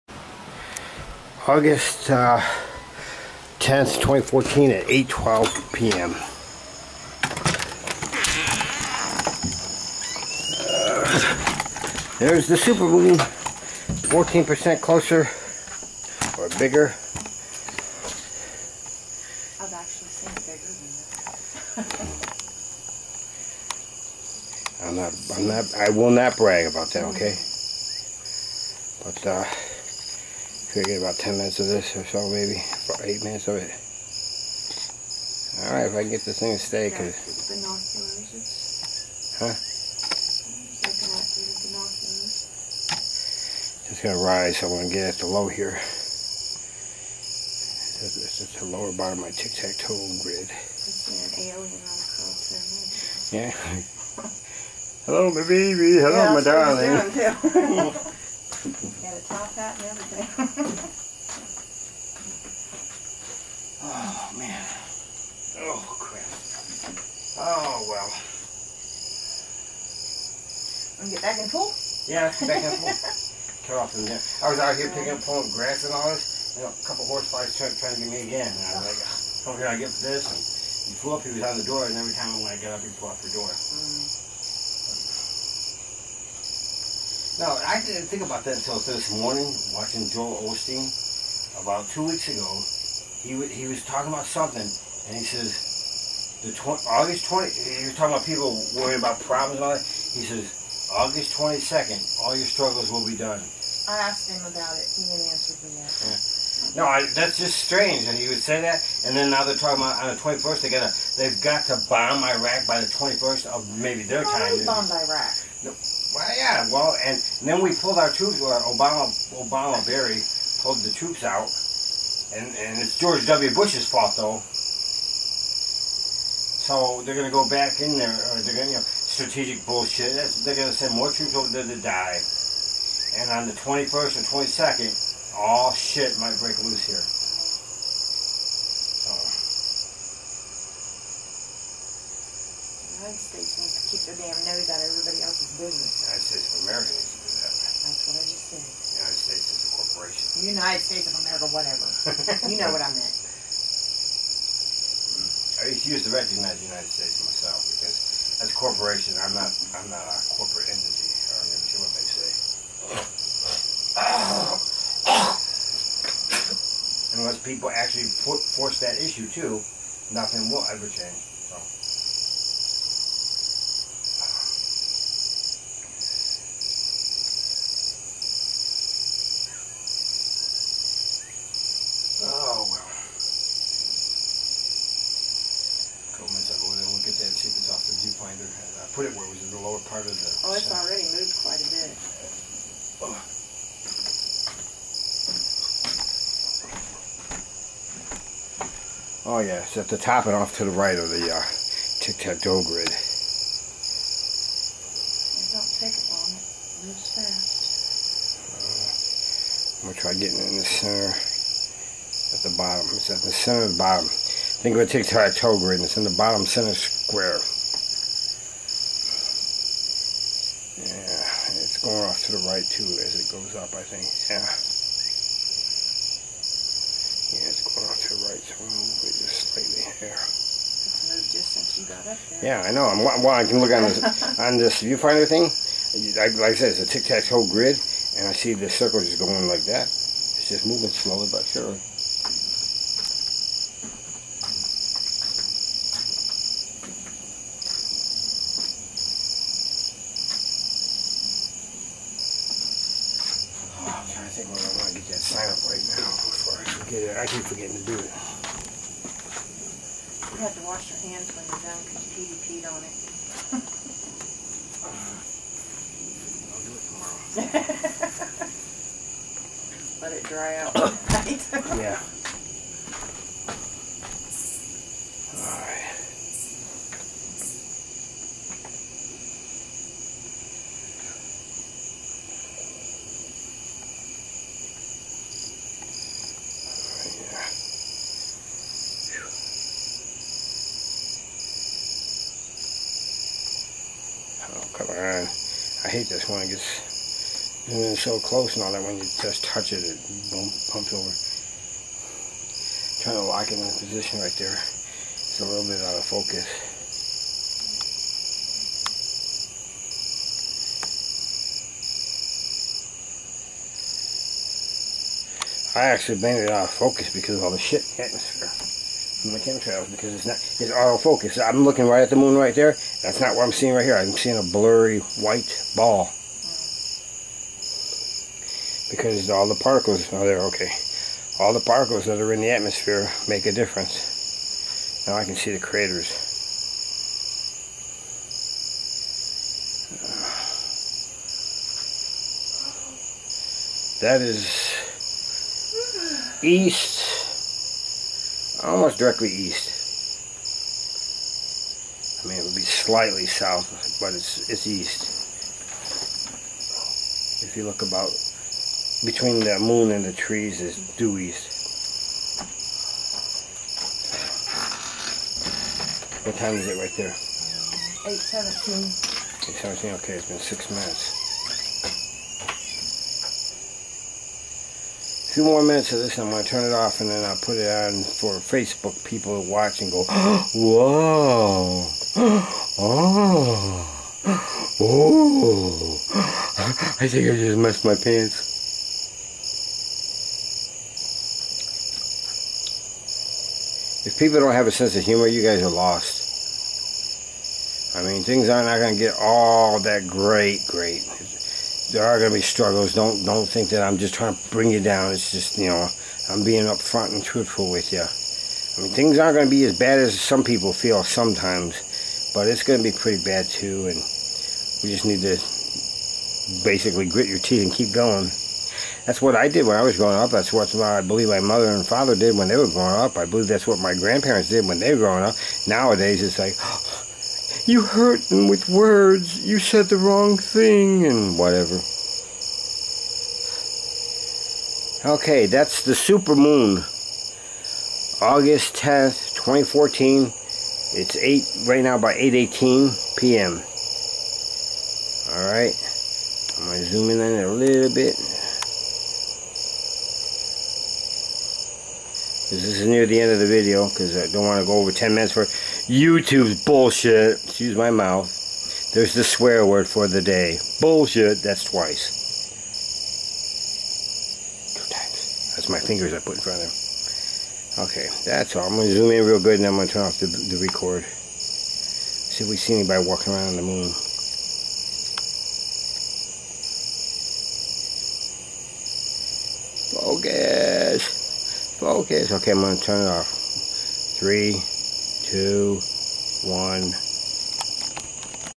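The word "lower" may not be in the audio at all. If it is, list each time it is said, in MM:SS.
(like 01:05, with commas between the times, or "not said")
00:48, 03:09.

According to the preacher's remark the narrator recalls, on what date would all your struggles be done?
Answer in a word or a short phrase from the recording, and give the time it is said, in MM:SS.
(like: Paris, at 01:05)
August 22nd, at 01:40.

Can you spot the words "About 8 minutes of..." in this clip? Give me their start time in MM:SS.
00:32.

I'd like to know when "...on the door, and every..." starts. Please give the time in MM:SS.
01:21.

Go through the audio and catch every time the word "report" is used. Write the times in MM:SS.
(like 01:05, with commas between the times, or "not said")
not said.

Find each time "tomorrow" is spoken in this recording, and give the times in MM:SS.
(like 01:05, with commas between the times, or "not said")
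04:27.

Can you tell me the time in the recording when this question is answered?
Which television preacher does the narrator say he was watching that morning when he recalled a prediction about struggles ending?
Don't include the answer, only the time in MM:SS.
01:30.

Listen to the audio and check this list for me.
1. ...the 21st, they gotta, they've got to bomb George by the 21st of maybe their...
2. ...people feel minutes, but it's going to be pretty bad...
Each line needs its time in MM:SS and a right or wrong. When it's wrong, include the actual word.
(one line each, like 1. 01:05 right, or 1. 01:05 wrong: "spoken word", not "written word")
1. 01:50 wrong: "Iraq", not "George"
2. 06:50 wrong: "sometimes", not "minutes".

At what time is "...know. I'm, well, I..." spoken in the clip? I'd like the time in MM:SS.
03:52.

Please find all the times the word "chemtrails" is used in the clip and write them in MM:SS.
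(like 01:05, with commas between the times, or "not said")
05:19.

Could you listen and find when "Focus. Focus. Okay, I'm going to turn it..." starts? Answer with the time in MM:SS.
07:59.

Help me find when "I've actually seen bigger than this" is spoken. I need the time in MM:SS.
00:19.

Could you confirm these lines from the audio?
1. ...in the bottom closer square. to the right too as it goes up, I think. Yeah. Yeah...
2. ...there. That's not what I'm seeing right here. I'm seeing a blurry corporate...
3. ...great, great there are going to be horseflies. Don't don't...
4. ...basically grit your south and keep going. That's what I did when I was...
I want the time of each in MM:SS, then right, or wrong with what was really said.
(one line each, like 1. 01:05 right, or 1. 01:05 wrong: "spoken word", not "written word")
1. 03:35 wrong: "center", not "closer"
2. 05:22 wrong: "white", not "corporate"
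3. 06:40 wrong: "struggles", not "horseflies"
4. 06:56 wrong: "teeth", not "south".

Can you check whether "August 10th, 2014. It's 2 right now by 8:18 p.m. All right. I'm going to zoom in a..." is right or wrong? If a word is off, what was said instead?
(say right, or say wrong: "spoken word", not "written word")
wrong: "8", not "2".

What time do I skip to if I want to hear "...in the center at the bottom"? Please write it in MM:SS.
03:30.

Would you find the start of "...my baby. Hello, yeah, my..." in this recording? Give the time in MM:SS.
00:55.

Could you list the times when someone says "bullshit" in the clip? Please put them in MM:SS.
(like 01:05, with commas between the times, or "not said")
02:09, 07:36, 07:40.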